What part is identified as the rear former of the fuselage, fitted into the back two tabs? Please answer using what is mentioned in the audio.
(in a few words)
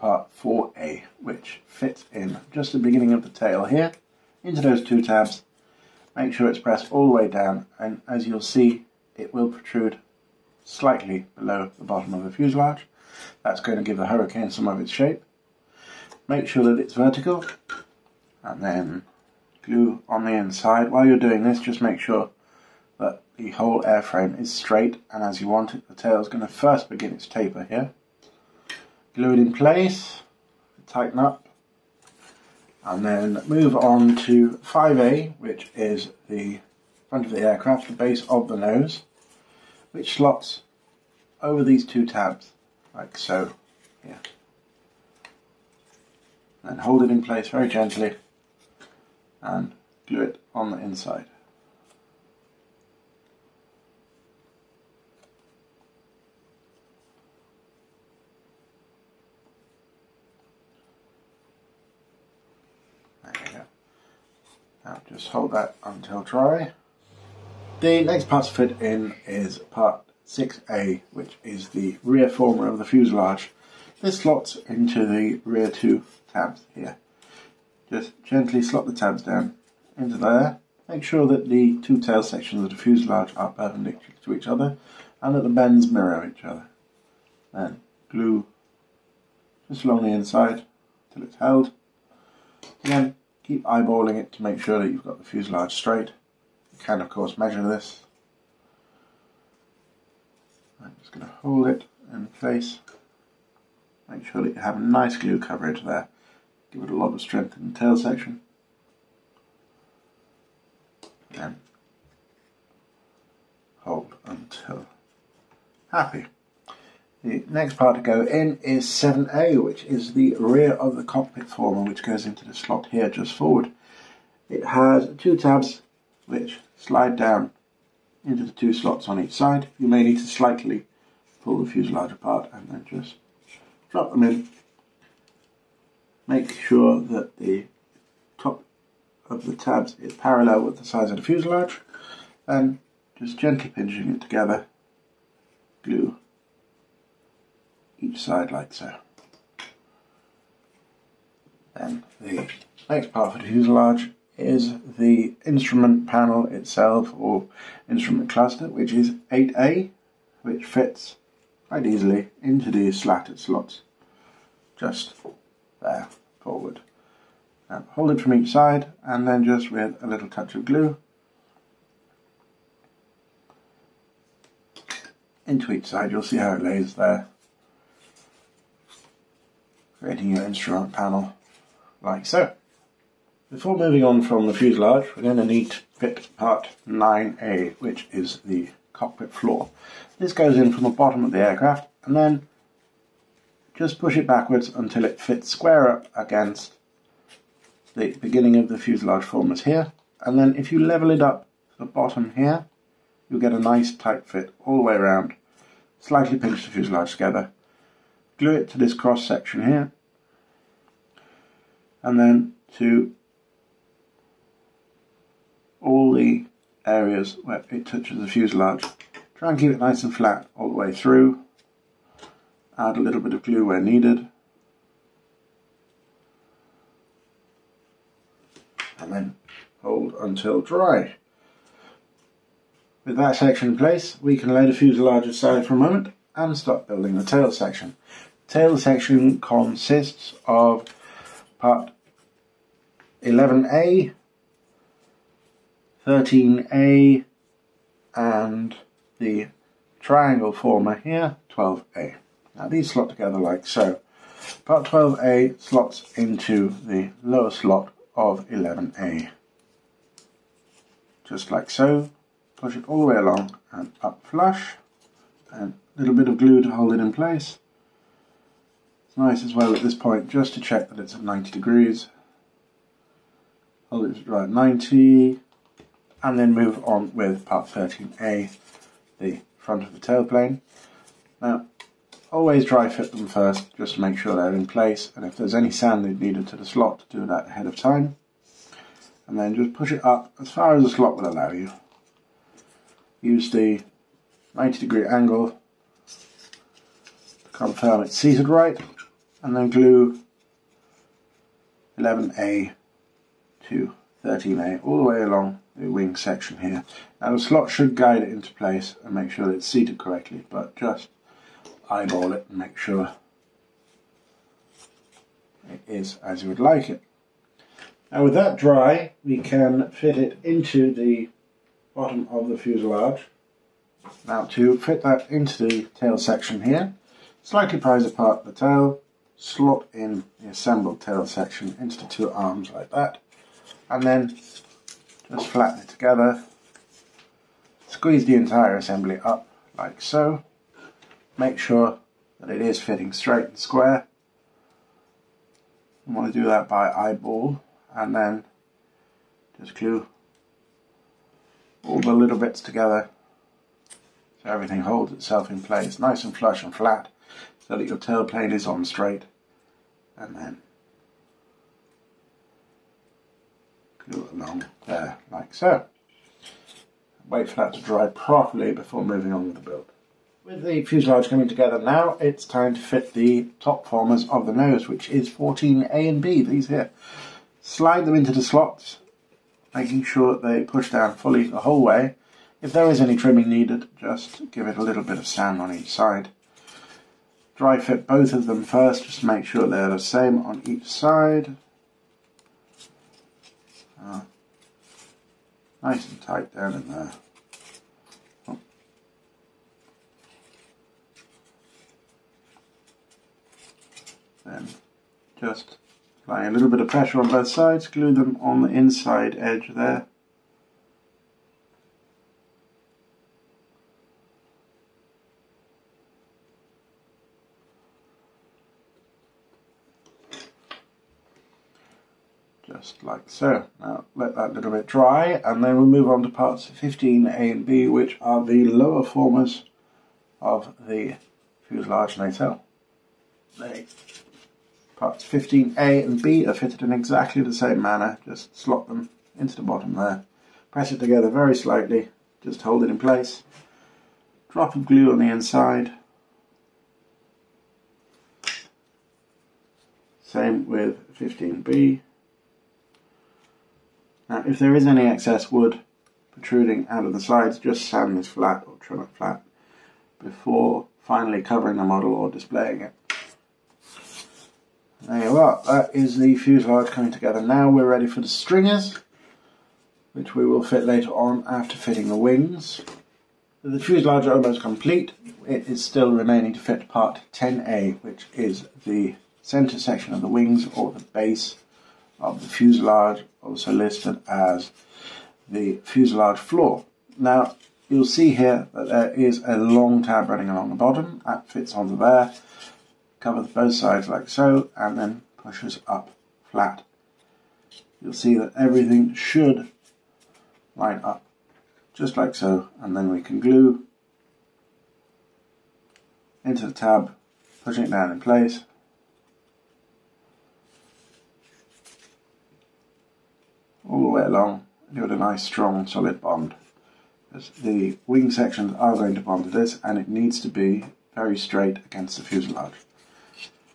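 6A.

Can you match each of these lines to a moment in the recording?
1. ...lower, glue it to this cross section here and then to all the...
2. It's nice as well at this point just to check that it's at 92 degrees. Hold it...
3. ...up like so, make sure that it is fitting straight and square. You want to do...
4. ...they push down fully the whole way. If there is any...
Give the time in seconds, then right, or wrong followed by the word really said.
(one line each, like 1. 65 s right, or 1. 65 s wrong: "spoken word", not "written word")
1. 207 s wrong: "together", not "lower"
2. 269 s wrong: "90", not "92"
3. 339 s right
4. 380 s right.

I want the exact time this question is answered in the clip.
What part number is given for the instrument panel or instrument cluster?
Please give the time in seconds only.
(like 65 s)
159 s.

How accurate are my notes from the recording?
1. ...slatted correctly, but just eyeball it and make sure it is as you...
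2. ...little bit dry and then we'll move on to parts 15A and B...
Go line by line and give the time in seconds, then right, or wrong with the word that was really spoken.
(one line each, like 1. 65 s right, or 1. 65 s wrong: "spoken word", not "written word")
1. 309 s wrong: "seated", not "slatted"
2. 424 s right.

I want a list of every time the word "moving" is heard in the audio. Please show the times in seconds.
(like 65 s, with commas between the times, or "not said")
183 s, 369 s.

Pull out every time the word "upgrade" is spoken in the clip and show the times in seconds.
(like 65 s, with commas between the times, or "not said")
not said.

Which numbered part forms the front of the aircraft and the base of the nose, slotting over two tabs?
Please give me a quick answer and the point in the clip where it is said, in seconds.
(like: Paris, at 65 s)
5A, at 34 s.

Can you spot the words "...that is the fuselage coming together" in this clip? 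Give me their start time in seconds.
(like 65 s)
465 s.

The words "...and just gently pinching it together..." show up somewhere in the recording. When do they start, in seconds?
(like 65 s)
142 s.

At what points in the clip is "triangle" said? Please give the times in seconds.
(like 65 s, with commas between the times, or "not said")
249 s.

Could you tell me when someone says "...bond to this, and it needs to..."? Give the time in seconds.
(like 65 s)
519 s.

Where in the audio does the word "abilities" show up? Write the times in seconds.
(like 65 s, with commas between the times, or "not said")
not said.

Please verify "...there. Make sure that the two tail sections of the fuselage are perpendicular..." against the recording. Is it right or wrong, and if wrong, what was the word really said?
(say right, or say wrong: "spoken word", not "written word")
right.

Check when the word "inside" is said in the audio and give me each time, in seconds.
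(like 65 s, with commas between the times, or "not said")
20 s, 50 s, 90 s, 408 s, 445 s.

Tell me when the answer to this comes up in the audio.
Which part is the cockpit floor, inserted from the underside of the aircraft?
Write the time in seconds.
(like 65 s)
186 s.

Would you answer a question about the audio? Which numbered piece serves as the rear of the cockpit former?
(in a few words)
7A.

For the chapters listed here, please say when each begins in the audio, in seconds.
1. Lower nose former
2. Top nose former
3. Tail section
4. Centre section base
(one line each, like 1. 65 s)
1. 434 s
2. 370 s
3. 237 s
4. 474 s.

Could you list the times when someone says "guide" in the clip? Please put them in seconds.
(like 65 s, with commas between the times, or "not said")
307 s.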